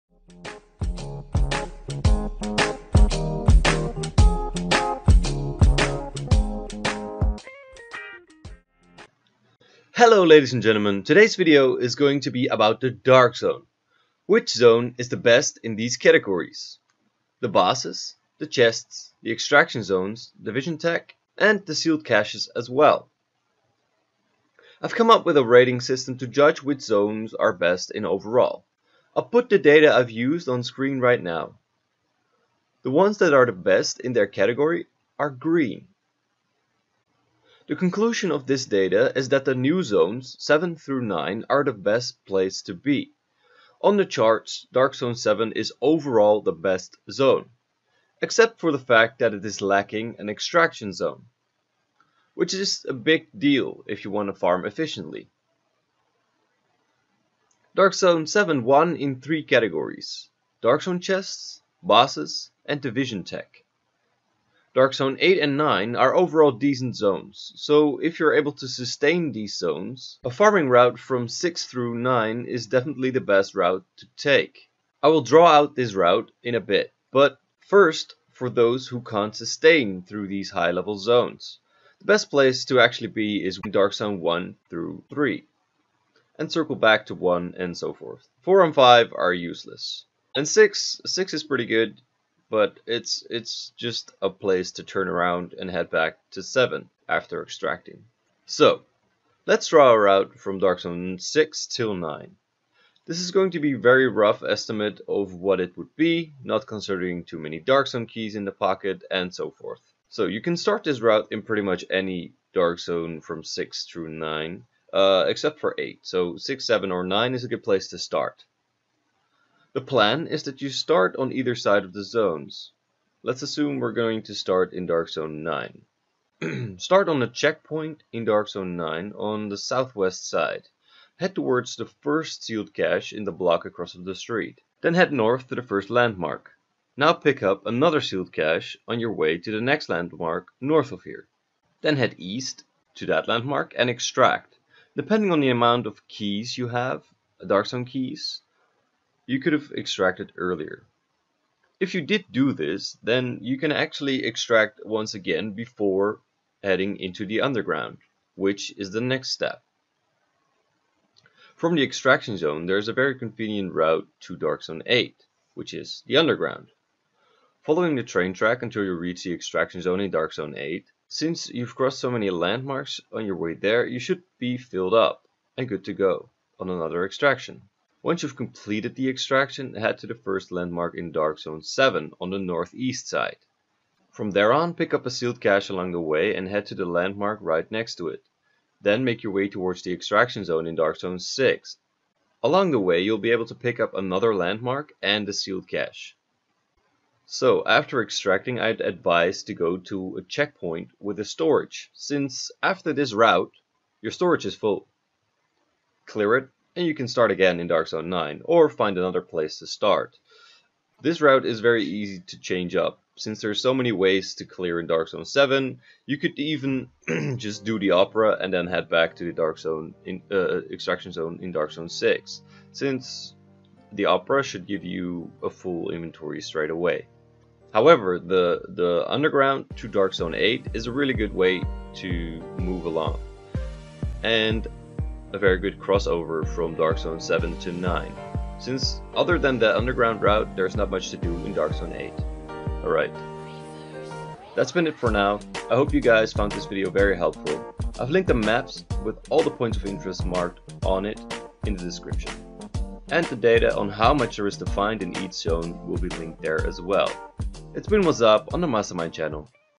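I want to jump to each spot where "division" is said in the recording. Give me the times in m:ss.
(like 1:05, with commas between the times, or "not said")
0:20, 1:02.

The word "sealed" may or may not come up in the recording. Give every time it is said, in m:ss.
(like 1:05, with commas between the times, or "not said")
0:21, 2:12, 2:18, 3:05, 3:15.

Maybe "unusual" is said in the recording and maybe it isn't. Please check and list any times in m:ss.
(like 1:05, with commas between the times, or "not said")
not said.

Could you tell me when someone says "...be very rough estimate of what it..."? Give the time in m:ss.
1:43.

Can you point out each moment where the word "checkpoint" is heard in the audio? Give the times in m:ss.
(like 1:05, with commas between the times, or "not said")
2:07, 3:20.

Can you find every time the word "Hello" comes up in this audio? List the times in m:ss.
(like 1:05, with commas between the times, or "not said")
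0:10.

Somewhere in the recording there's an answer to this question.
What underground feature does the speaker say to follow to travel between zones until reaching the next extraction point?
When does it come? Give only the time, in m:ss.
2:48.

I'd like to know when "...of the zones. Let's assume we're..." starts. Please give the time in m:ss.
2:01.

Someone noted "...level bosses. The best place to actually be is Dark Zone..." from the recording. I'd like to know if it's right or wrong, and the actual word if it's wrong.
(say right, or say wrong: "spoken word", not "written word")
wrong: "zones", not "bosses".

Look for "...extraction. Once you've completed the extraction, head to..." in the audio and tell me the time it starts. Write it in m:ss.
2:57.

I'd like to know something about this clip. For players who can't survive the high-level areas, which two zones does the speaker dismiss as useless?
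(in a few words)
4 and 5.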